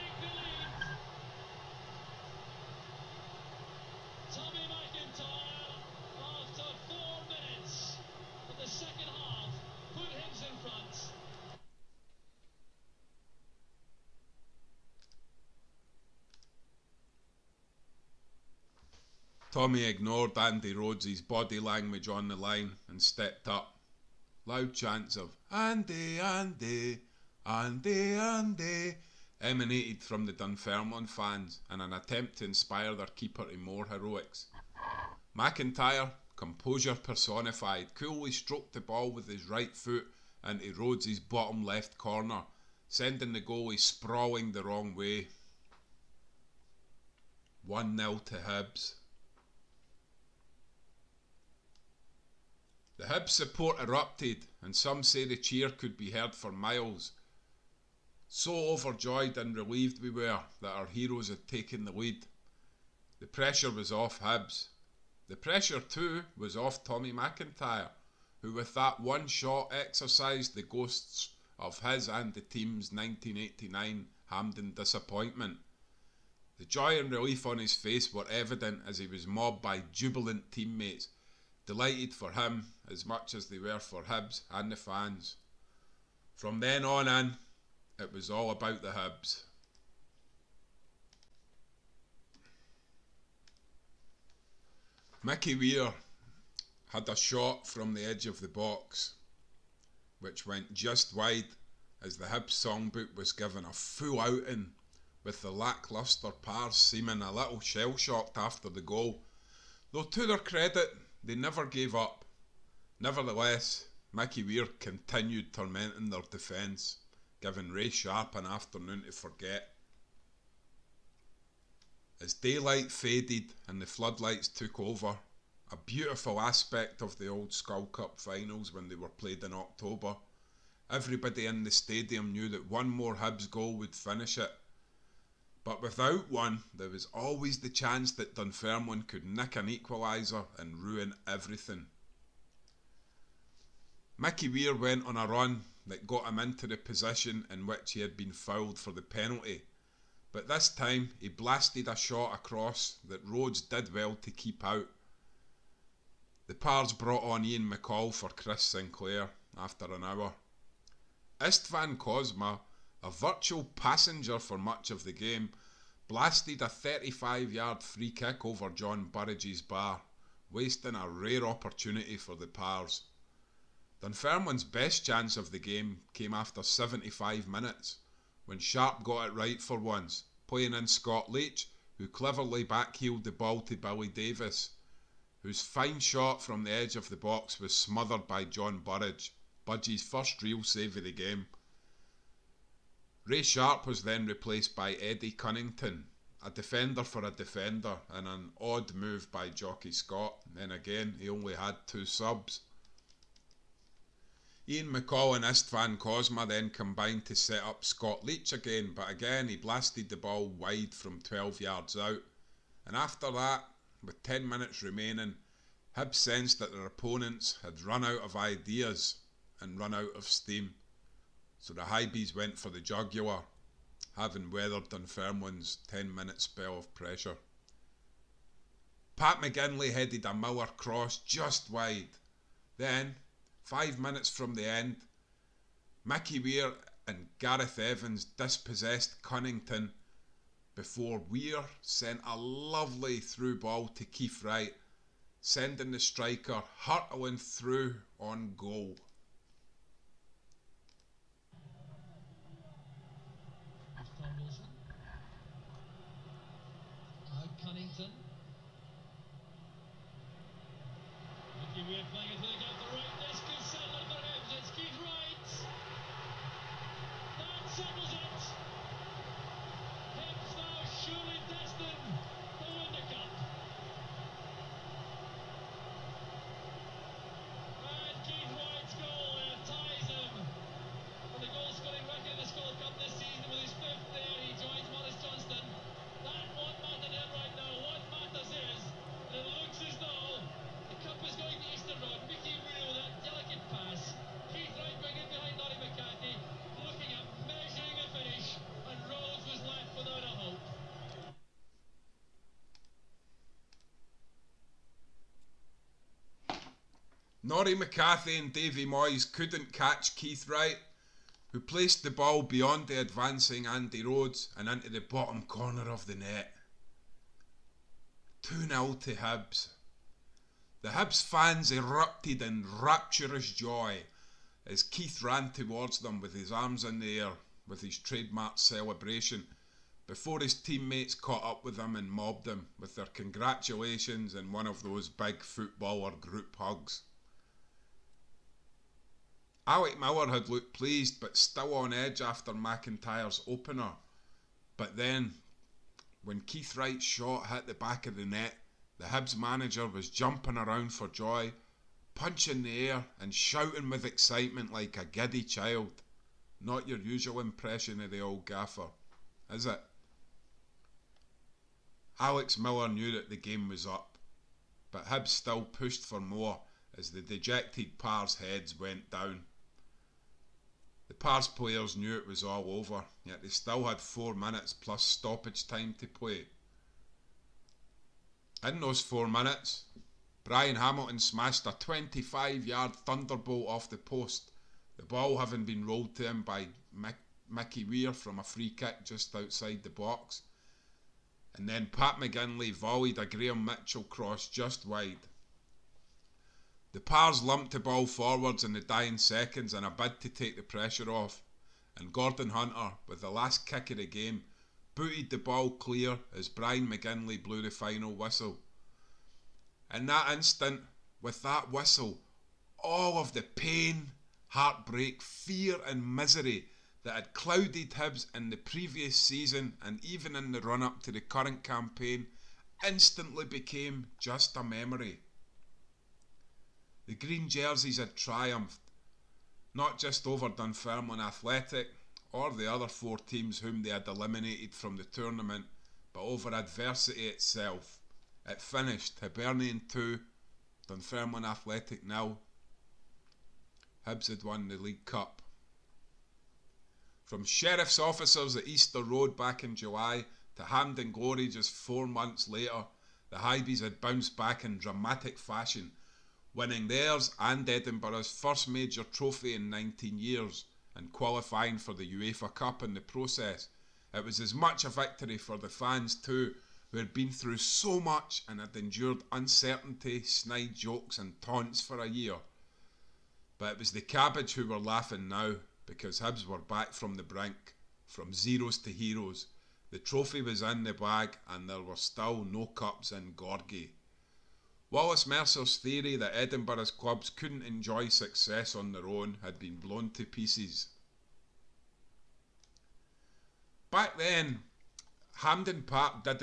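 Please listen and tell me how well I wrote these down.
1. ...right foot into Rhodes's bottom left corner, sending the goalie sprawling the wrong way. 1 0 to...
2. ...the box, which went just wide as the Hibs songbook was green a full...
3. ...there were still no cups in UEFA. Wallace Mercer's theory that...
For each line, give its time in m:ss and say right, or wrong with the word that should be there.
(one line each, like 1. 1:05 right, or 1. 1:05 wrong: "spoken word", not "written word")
1. 0:39 right
2. 1:38 wrong: "given", not "green"
3. 8:01 wrong: "Gorgie", not "UEFA".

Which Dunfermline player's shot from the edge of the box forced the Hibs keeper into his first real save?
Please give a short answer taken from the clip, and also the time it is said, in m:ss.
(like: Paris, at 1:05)
Billy Davies, at 3:03.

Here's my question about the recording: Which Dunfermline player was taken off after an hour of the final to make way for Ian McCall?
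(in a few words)
Chris Sinclair.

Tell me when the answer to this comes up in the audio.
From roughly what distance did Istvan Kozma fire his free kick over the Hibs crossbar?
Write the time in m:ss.
2:46.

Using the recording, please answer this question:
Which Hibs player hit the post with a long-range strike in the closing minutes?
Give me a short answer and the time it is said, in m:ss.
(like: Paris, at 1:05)
Brian Hamilton, at 6:20.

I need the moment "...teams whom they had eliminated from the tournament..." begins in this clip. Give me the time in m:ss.
7:13.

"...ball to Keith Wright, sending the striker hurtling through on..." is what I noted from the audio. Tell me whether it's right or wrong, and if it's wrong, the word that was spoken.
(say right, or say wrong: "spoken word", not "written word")
right.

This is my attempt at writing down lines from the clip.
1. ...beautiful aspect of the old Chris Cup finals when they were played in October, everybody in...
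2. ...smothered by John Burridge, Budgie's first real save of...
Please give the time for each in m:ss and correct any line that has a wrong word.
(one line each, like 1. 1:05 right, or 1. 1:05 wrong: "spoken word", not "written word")
1. 2:05 wrong: "Skol", not "Chris"
2. 3:07 right.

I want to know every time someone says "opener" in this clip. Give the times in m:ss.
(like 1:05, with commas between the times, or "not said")
5:43.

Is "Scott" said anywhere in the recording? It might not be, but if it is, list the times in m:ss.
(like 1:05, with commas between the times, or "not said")
3:00, 3:19, 3:27.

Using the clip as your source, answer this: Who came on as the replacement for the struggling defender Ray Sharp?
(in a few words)
Eddie Cunnington.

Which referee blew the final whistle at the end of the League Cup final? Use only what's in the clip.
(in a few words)
Brian McGinlay.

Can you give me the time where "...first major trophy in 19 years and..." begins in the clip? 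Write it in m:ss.
7:38.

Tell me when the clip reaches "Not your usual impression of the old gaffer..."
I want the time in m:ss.
5:56.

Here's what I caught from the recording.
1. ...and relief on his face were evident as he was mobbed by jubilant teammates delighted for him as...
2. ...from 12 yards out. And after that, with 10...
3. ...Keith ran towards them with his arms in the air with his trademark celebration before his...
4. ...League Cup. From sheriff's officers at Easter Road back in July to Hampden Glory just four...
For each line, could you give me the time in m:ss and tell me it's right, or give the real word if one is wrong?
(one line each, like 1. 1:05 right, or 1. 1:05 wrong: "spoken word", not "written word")
1. 1:16 right
2. 3:30 right
3. 5:24 right
4. 7:24 right.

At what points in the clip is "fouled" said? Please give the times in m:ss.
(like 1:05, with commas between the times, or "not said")
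2:28.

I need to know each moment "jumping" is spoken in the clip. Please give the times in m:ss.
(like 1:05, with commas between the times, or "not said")
5:50.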